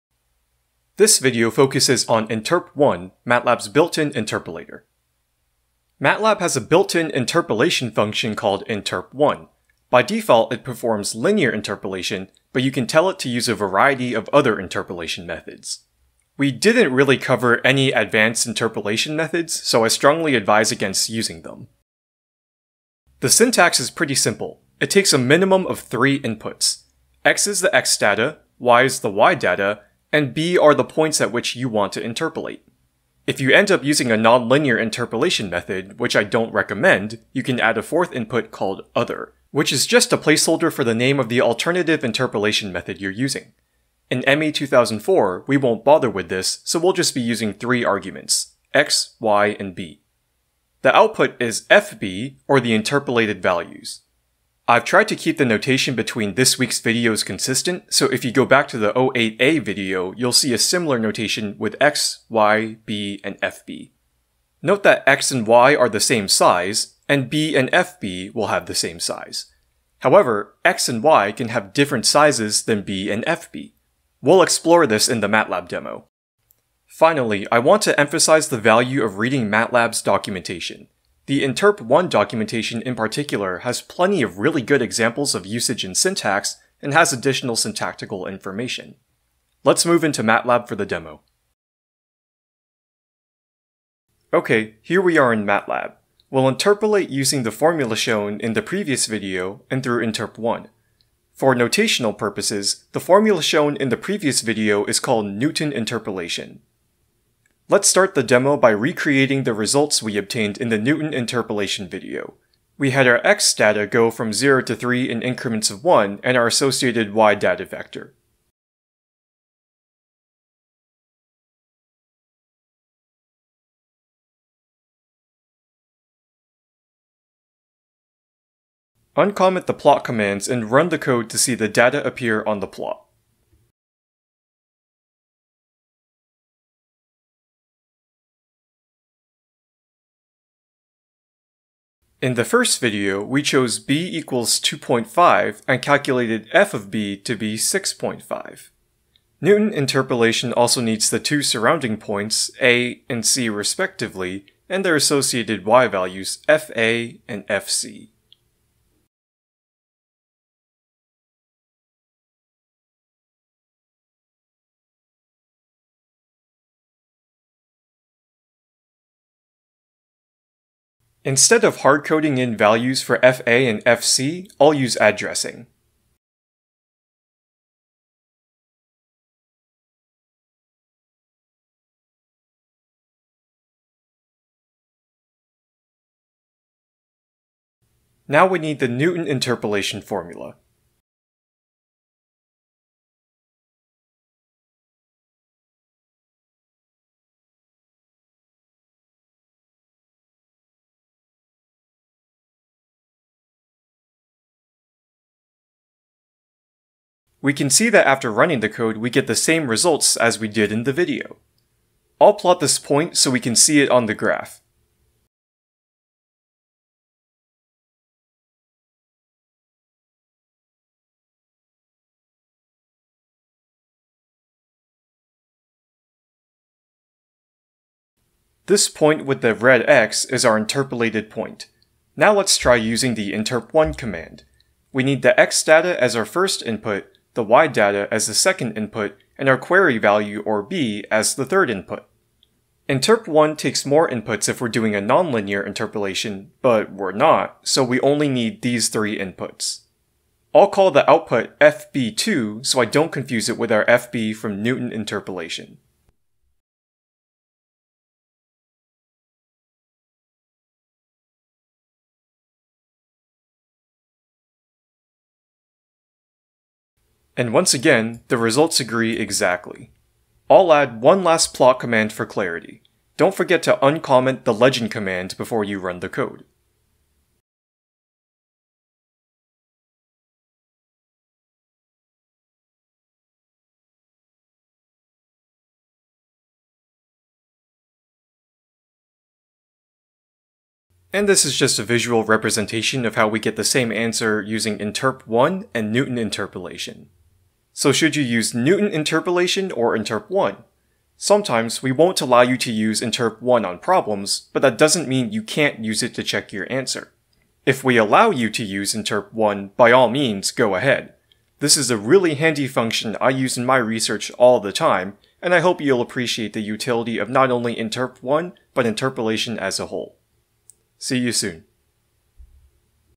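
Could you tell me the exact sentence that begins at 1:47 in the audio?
Let's start the demo by recreating the results we obtained in the Newton interpolation video.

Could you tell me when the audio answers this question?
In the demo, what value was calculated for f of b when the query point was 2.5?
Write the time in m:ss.
2:27.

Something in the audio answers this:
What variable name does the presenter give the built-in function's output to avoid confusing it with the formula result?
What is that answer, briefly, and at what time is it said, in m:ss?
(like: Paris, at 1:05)
FB2, at 4:11.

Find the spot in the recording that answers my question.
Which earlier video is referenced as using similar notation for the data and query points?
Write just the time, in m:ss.
0:58.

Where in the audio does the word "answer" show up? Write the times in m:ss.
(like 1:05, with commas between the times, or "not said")
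4:53, 5:06.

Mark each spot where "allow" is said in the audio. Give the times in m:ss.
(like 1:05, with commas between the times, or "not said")
5:02, 5:07.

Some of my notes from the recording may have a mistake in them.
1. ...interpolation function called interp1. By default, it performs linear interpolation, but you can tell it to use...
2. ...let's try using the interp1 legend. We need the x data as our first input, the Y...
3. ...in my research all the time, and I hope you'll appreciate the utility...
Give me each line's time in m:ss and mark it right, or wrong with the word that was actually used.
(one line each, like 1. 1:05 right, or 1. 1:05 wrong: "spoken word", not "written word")
1. 0:07 right
2. 3:52 wrong: "command", not "legend"
3. 5:13 right.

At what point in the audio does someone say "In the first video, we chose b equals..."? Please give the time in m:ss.
2:22.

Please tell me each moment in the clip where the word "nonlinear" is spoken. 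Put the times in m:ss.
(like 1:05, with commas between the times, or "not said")
0:34, 4:05.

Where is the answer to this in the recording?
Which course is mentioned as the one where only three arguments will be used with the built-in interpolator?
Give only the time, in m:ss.
0:44.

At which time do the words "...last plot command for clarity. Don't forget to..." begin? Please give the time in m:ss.
4:31.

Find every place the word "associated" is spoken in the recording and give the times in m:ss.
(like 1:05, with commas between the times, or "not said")
1:56, 2:34.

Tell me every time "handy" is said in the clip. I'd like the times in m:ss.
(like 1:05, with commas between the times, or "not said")
5:12.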